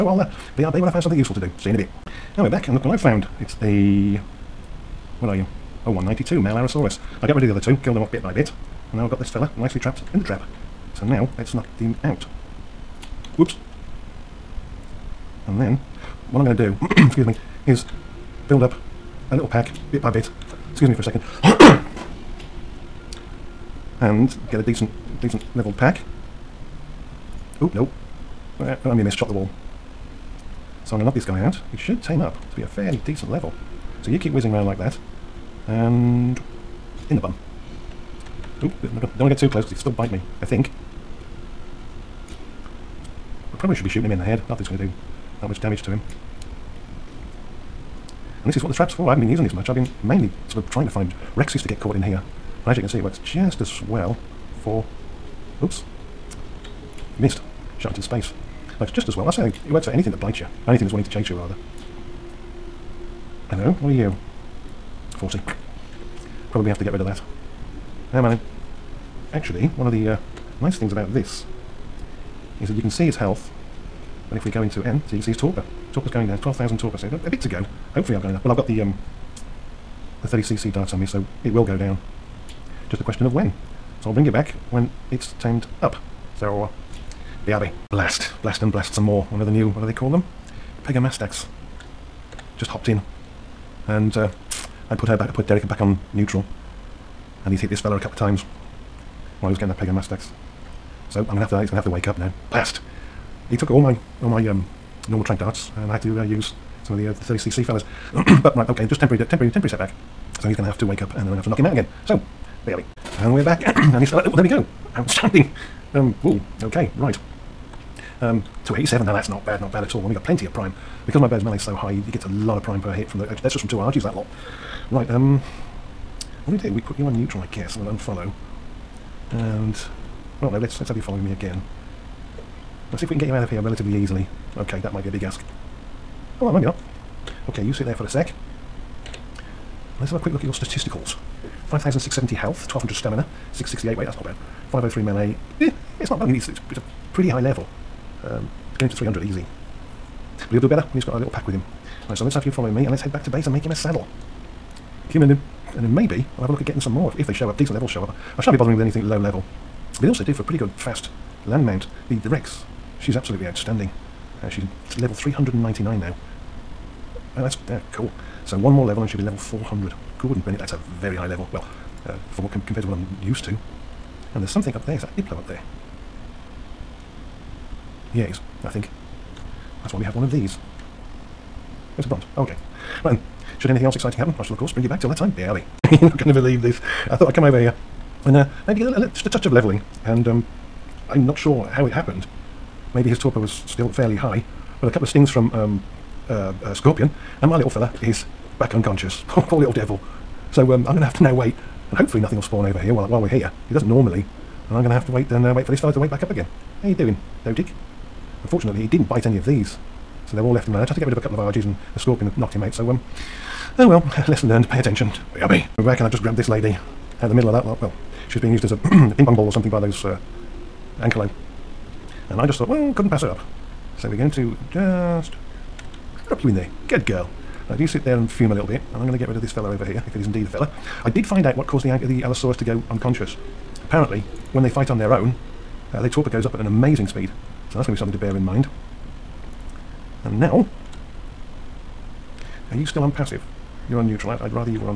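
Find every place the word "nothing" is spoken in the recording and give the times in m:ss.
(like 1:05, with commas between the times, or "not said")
3:22.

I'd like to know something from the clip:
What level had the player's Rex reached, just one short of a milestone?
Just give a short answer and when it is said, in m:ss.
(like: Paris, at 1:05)
399, at 2:45.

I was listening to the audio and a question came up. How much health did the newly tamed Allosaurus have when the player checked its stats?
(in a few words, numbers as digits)
5,670.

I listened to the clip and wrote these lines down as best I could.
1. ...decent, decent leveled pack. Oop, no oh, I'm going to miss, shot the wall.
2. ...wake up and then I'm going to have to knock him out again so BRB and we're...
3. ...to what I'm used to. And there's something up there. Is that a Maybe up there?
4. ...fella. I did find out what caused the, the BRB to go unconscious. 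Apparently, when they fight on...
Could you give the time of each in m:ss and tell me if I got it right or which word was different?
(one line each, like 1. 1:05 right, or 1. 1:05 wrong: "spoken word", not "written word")
1. 0:24 right
2. 1:50 right
3. 2:52 wrong: "Diplo", not "Maybe"
4. 3:50 wrong: "Allosaurus", not "BRB".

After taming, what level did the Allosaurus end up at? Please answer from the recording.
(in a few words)
287.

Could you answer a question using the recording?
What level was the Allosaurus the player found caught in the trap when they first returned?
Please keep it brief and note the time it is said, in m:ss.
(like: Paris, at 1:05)
192, at 0:05.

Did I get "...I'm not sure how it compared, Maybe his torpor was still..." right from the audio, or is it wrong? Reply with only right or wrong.
wrong.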